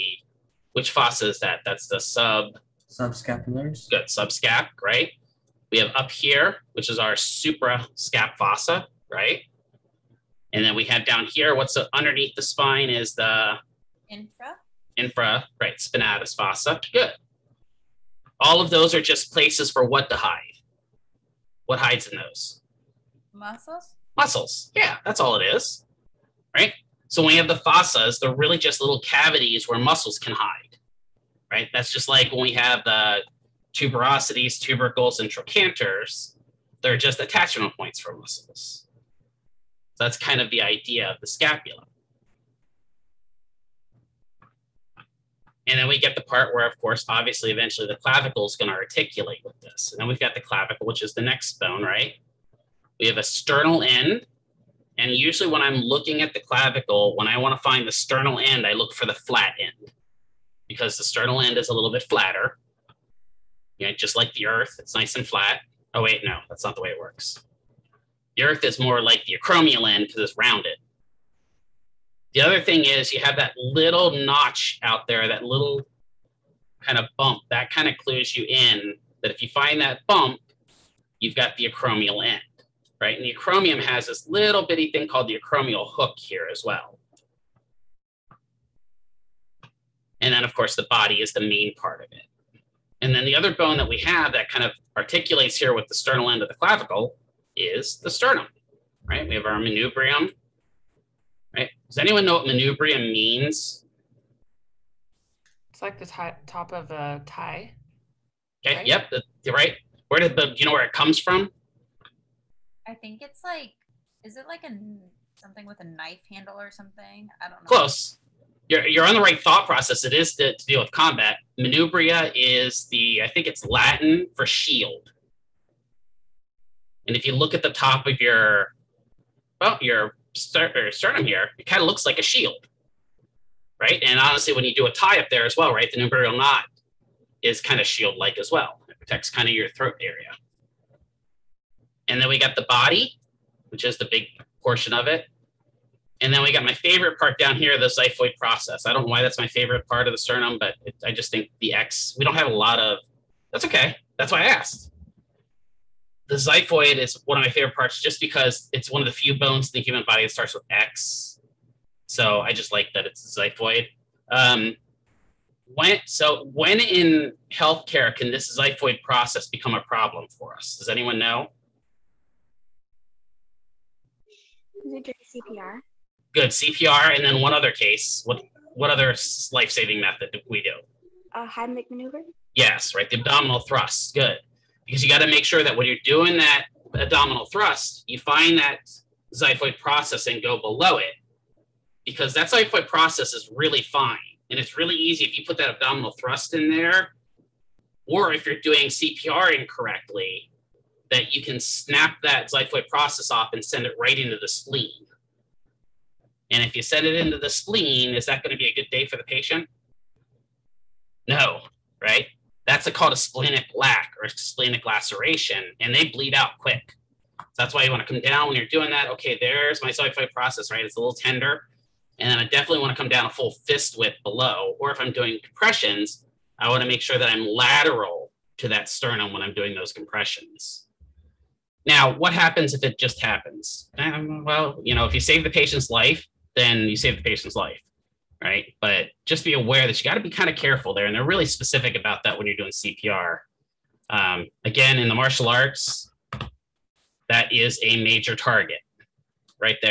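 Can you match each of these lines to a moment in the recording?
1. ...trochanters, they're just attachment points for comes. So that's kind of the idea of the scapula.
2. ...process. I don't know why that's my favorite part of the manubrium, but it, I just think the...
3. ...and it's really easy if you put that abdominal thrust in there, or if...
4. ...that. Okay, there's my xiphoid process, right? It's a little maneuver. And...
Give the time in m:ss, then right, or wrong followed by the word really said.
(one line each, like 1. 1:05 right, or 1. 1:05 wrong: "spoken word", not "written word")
1. 0:35 wrong: "muscles", not "comes"
2. 2:28 wrong: "sternum", not "manubrium"
3. 3:14 right
4. 3:38 wrong: "tender", not "maneuver".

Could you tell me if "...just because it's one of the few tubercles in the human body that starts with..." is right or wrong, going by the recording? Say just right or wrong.
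wrong.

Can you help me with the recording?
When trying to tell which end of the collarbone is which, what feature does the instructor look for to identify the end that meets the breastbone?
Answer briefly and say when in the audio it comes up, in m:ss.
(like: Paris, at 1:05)
the flat end, at 0:59.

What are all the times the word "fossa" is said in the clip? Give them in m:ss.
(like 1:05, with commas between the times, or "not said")
0:00, 0:08, 0:16, 0:27.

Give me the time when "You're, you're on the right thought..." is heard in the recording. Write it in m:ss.
1:58.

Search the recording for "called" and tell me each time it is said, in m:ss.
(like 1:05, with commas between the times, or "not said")
1:25, 3:32.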